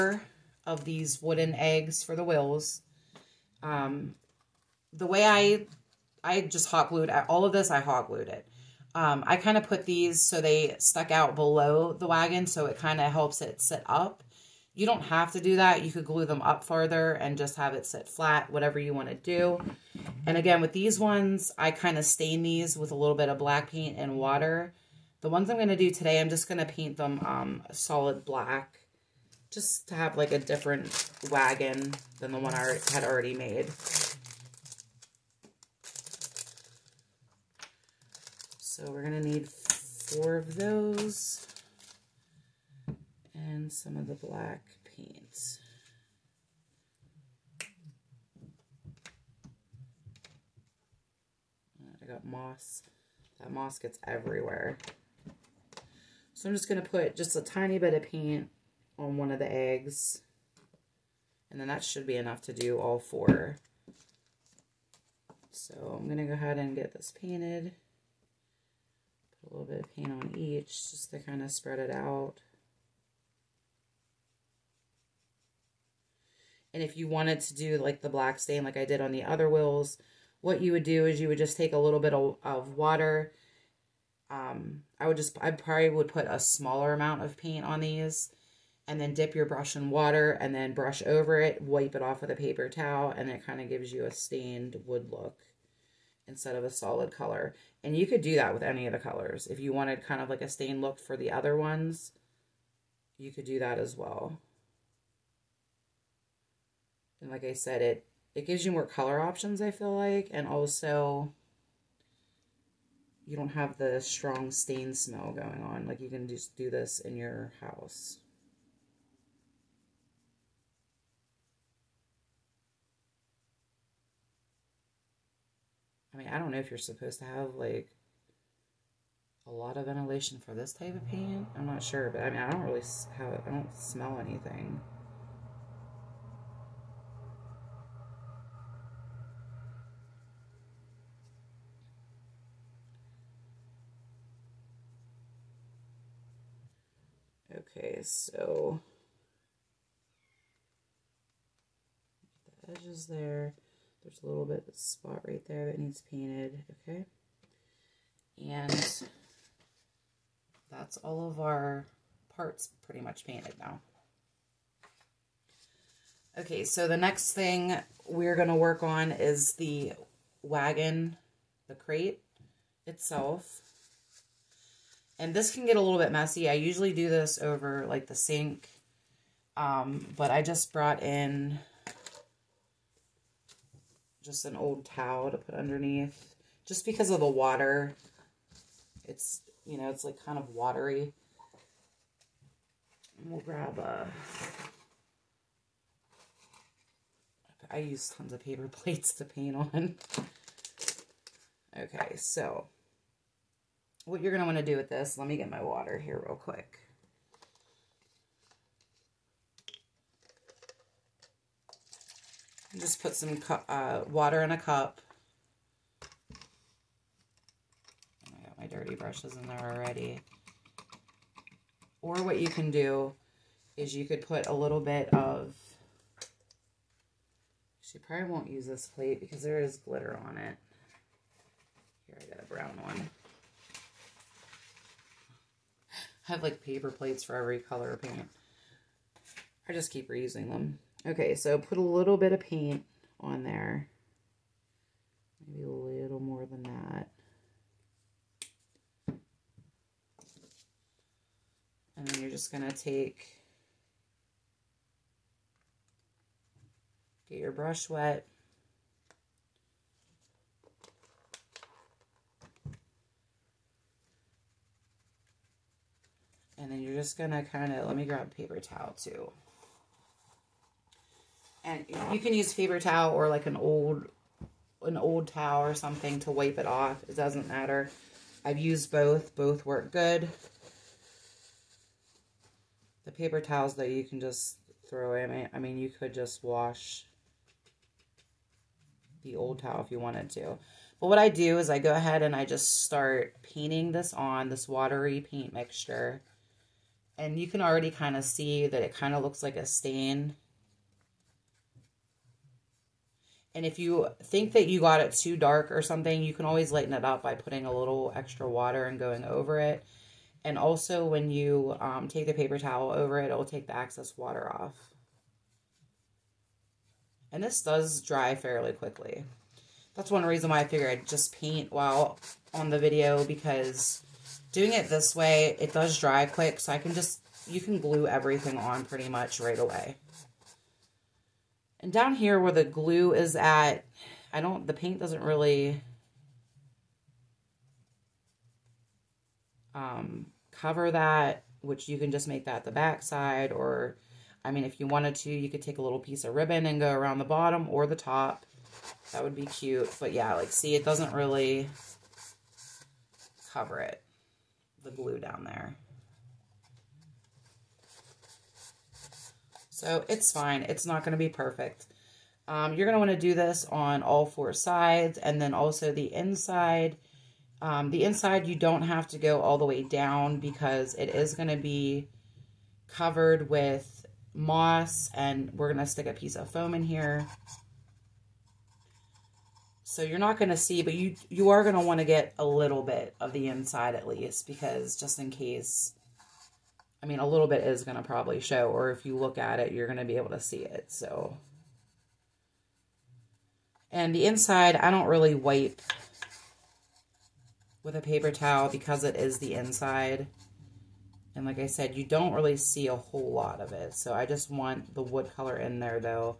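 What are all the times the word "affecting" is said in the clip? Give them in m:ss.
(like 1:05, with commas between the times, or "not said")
not said.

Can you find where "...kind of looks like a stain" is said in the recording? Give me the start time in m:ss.
4:58.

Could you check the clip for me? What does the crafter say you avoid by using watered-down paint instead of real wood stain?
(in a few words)
Strong stain smell.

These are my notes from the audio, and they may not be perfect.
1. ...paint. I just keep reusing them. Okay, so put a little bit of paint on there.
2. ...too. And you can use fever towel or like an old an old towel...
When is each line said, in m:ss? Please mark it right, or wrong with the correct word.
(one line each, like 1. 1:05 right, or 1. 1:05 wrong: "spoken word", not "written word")
1. 3:58 right
2. 4:28 right.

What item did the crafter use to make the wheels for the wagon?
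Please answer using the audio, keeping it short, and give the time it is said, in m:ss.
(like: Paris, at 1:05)
Wooden eggs, at 0:01.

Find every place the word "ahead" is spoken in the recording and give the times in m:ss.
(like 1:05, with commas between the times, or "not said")
1:06, 4:51.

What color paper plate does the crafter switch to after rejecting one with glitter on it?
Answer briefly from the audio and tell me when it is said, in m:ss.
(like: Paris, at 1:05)
Brown, at 3:52.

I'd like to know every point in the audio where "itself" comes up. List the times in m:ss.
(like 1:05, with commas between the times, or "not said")
2:52.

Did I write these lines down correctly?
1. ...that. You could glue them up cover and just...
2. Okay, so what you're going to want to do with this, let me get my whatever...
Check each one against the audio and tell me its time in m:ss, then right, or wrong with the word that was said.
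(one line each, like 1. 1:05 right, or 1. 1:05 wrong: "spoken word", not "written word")
1. 0:15 wrong: "farther", not "cover"
2. 3:21 wrong: "water", not "whatever".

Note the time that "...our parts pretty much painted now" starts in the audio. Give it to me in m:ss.
2:41.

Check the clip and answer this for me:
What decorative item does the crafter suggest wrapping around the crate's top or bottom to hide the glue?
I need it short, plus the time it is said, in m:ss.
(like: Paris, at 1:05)
Ribbon, at 5:46.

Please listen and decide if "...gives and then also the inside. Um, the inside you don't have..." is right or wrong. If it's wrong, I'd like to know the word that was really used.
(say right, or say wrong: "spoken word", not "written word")
wrong: "sides", not "gives".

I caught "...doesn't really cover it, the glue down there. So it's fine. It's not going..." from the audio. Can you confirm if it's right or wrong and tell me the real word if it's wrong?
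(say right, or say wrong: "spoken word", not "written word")
right.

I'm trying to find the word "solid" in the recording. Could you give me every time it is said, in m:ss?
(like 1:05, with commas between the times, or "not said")
0:27, 1:36.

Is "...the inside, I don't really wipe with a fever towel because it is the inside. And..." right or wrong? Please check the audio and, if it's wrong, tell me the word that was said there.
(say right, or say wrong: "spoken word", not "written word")
wrong: "paper", not "fever".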